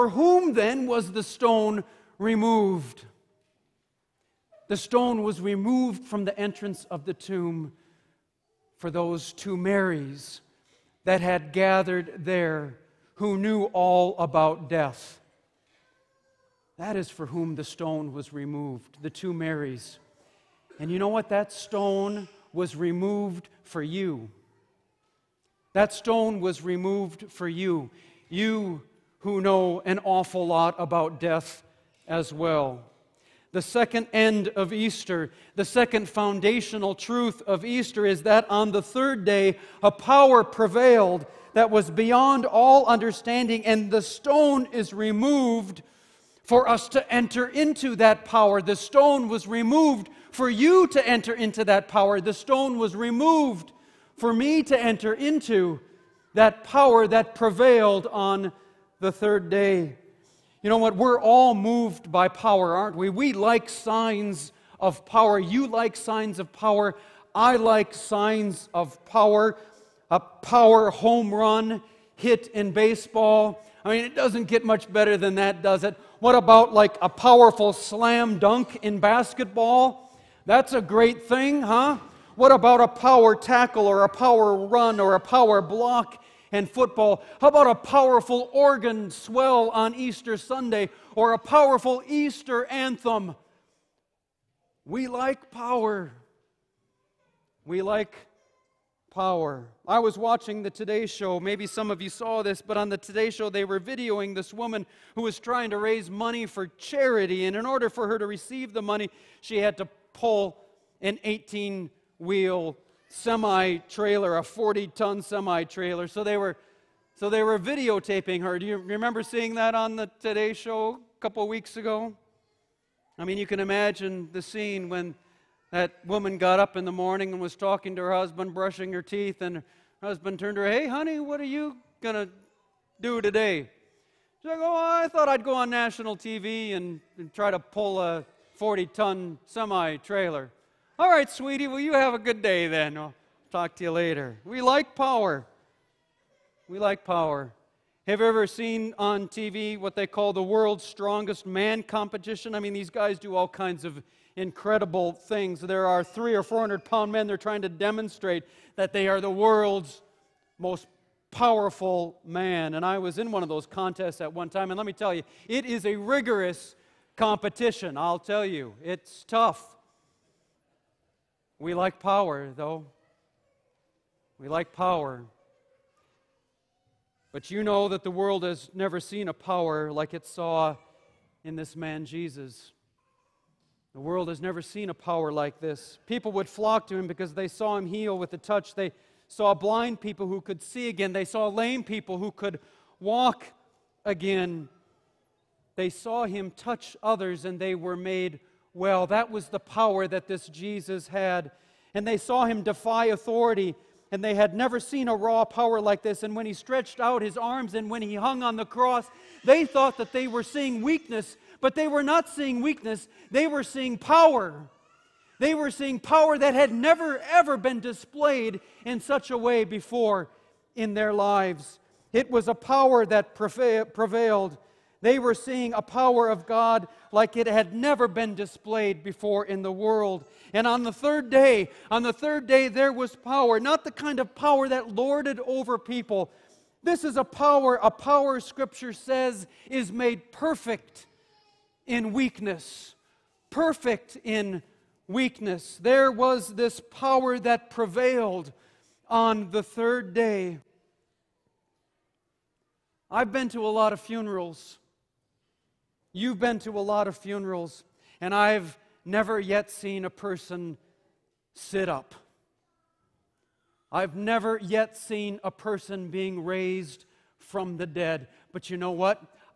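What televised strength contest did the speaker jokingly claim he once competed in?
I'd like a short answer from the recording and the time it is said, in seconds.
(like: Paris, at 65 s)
World's strongest man competition, at 150 s.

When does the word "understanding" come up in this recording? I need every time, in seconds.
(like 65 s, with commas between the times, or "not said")
42 s.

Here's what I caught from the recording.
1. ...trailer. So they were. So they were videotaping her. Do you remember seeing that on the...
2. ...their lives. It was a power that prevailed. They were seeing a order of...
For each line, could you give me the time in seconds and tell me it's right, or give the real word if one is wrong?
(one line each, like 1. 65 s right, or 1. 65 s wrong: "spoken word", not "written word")
1. 115 s right
2. 220 s wrong: "power", not "order".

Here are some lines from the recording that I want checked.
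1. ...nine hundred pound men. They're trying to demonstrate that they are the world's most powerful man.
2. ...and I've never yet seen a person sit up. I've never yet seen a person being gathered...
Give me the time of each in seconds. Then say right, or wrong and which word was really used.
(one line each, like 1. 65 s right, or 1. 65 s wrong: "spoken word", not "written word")
1. 156 s wrong: "four", not "nine"
2. 258 s wrong: "raised", not "gathered".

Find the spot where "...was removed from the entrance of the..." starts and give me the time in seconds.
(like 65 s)
5 s.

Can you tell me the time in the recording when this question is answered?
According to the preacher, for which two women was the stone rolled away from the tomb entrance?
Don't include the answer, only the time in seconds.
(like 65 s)
19 s.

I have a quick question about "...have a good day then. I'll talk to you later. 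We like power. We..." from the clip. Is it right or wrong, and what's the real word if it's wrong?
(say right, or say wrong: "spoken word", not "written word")
right.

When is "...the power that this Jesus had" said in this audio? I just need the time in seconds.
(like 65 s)
199 s.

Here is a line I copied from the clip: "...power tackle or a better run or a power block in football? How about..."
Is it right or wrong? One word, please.
wrong.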